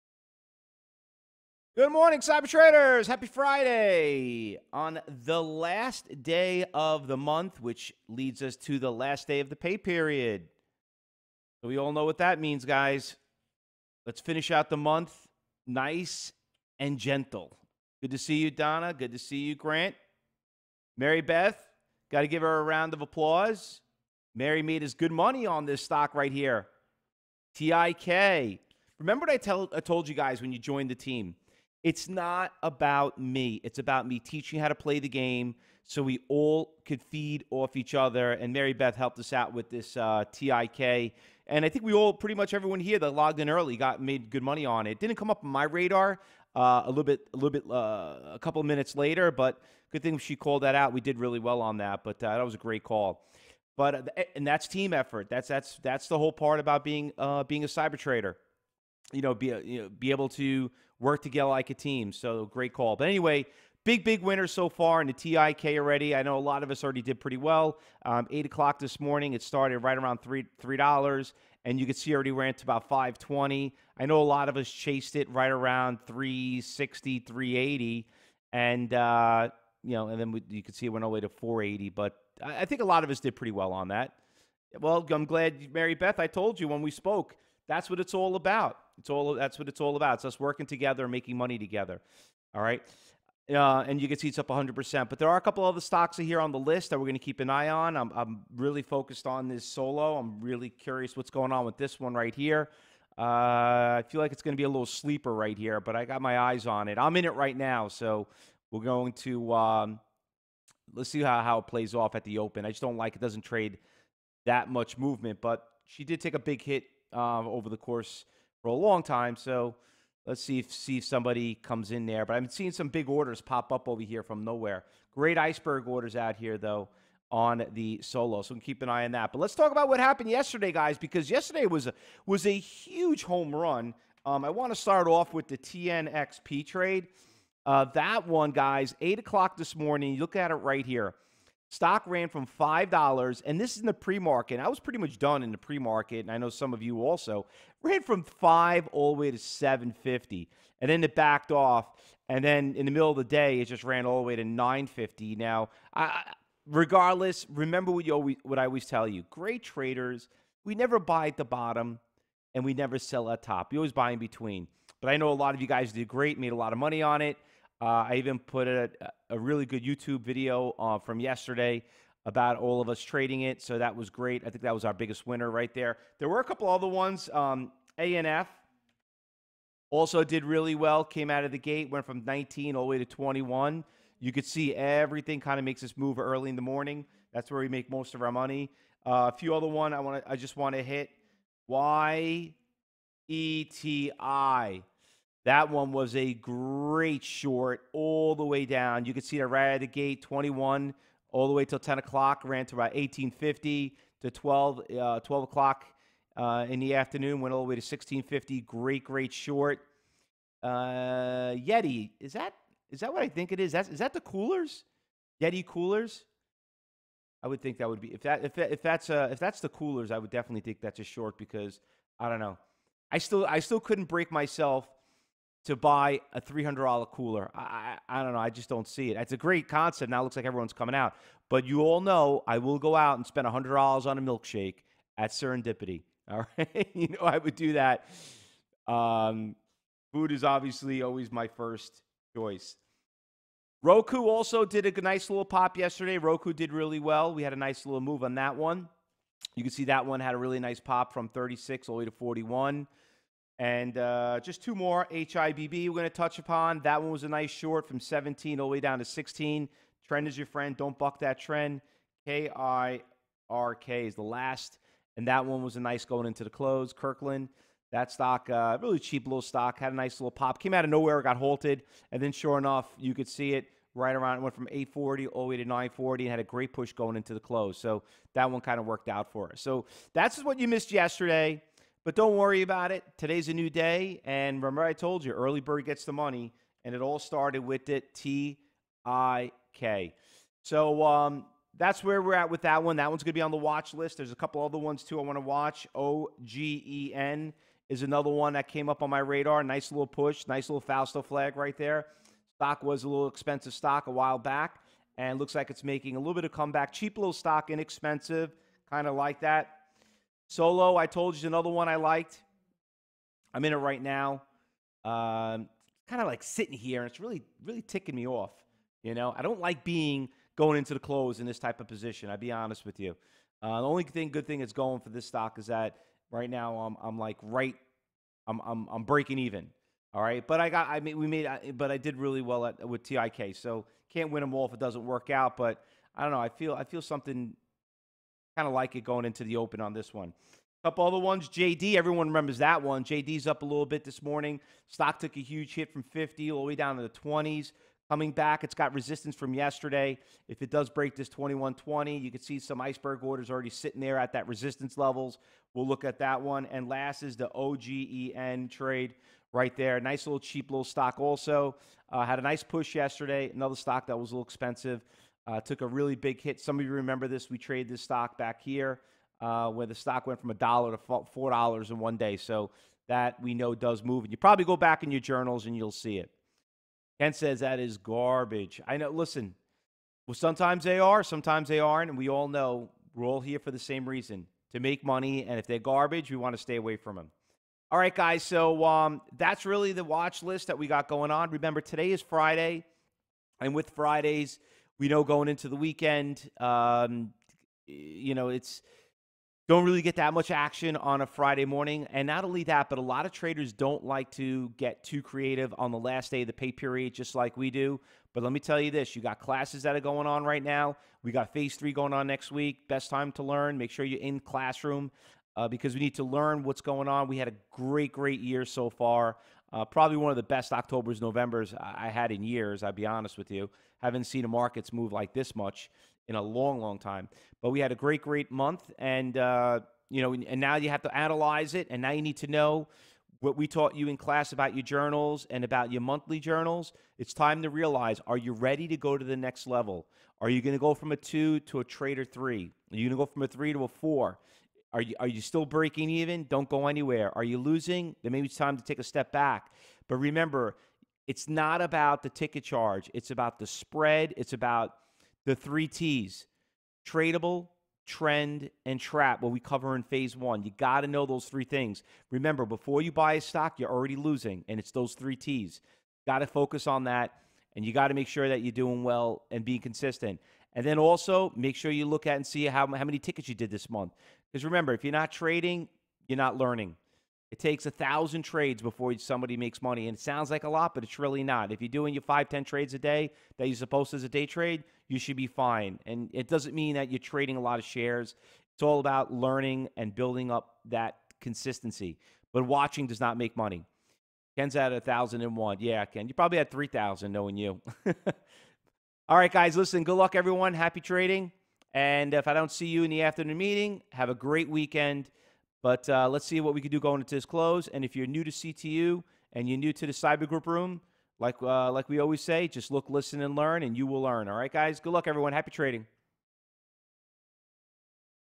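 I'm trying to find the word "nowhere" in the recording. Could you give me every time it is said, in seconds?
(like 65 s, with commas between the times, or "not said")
124 s, 270 s.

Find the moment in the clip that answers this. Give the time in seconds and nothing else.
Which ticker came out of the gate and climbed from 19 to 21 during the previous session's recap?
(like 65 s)
177 s.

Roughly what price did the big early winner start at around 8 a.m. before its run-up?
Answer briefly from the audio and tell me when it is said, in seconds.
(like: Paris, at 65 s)
$3, at 70 s.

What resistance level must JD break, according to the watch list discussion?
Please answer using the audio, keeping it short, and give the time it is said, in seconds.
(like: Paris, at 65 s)
21.20, at 351 s.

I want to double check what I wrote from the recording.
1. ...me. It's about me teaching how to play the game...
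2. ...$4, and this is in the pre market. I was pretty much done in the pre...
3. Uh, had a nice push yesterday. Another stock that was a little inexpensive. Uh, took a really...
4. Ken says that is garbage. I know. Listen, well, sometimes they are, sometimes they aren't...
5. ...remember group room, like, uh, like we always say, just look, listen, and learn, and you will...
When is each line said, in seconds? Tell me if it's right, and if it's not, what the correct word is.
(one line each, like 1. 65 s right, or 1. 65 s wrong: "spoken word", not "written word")
1. 33 s right
2. 142 s wrong: "5", not "4"
3. 362 s wrong: "expensive", not "inexpensive"
4. 377 s right
5. 510 s wrong: "cyber", not "remember".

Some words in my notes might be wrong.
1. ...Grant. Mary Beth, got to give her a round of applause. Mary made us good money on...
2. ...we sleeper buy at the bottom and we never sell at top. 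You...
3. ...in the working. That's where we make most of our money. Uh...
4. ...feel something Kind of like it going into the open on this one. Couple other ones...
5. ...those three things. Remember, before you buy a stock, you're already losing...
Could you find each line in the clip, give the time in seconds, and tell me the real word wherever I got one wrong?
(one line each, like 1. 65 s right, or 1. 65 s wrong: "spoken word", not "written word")
1. 19 s right
2. 160 s wrong: "never", not "sleeper"
3. 186 s wrong: "morning", not "working"
4. 336 s right
5. 461 s right.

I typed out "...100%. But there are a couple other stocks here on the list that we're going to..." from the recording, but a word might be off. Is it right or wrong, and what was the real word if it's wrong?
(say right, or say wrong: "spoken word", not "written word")
right.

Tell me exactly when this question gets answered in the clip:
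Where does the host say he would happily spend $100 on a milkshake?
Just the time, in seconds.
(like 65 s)
235 s.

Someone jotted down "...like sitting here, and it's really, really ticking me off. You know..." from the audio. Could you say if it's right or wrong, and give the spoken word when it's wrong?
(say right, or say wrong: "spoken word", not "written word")
right.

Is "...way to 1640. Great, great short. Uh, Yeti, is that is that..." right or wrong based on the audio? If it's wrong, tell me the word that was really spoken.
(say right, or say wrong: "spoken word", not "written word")
wrong: "1650", not "1640".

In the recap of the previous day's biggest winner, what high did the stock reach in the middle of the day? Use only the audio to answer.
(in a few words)
9.50.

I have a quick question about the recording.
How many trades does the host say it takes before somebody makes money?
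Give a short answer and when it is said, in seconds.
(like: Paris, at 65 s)
1,000, at 477 s.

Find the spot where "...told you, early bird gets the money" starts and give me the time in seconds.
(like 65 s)
284 s.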